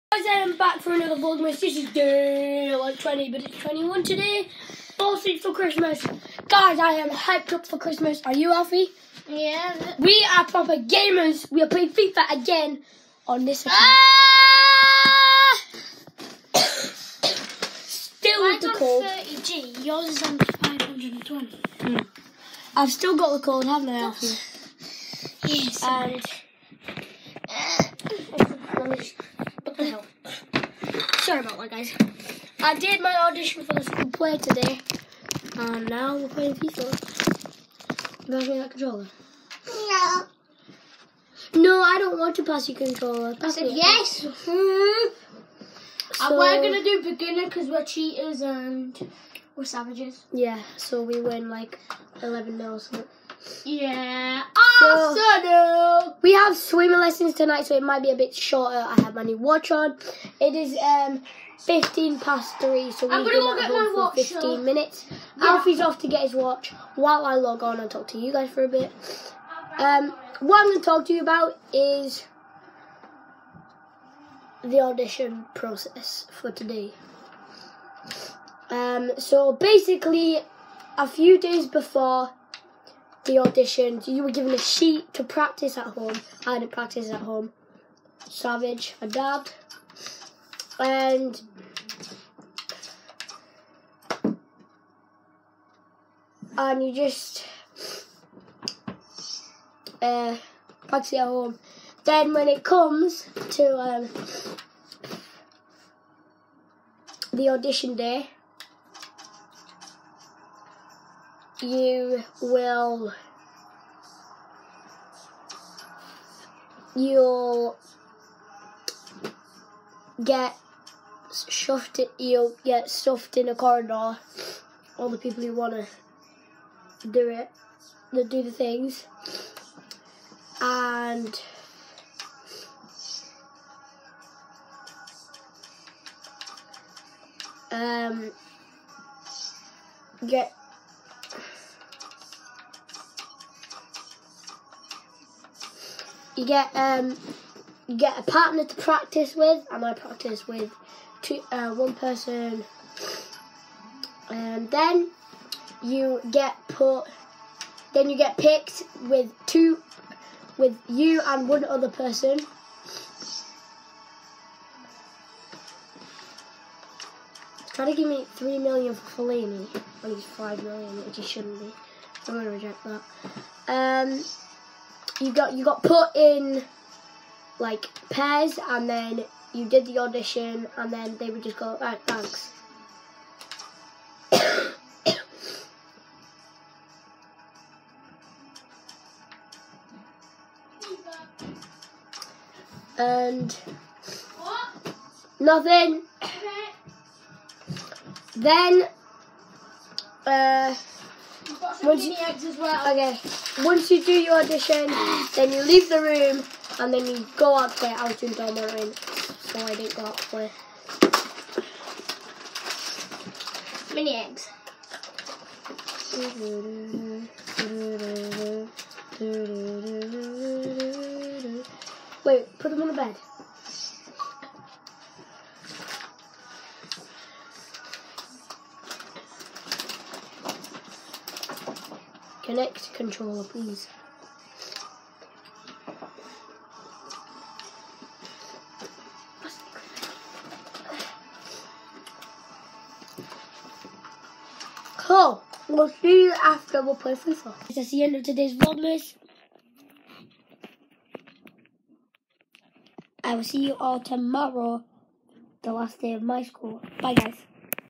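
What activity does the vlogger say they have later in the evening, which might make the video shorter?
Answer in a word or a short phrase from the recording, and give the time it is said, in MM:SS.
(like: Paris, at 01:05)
Swimming lessons, at 00:56.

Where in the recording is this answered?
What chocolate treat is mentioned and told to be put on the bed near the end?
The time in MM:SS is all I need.
03:33.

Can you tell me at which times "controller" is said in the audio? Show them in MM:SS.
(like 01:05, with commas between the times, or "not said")
00:38, 00:42, 03:52.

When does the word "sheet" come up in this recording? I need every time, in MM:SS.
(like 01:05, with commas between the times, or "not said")
01:24.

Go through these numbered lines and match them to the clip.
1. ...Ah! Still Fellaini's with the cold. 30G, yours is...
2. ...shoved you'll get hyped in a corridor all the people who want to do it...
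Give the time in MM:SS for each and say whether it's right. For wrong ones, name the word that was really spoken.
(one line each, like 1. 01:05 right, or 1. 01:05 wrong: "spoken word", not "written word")
1. 00:13 wrong: "Mine", not "Fellaini"
2. 02:01 wrong: "stuffed", not "hyped".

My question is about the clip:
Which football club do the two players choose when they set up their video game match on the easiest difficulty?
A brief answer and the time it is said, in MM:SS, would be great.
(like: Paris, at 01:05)
Arsenal, at 00:54.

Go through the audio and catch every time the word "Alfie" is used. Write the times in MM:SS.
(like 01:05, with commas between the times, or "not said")
00:08, 00:24, 01:05.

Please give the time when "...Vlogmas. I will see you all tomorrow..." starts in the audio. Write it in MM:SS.
04:08.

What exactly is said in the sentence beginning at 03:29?
So I didn't go out there.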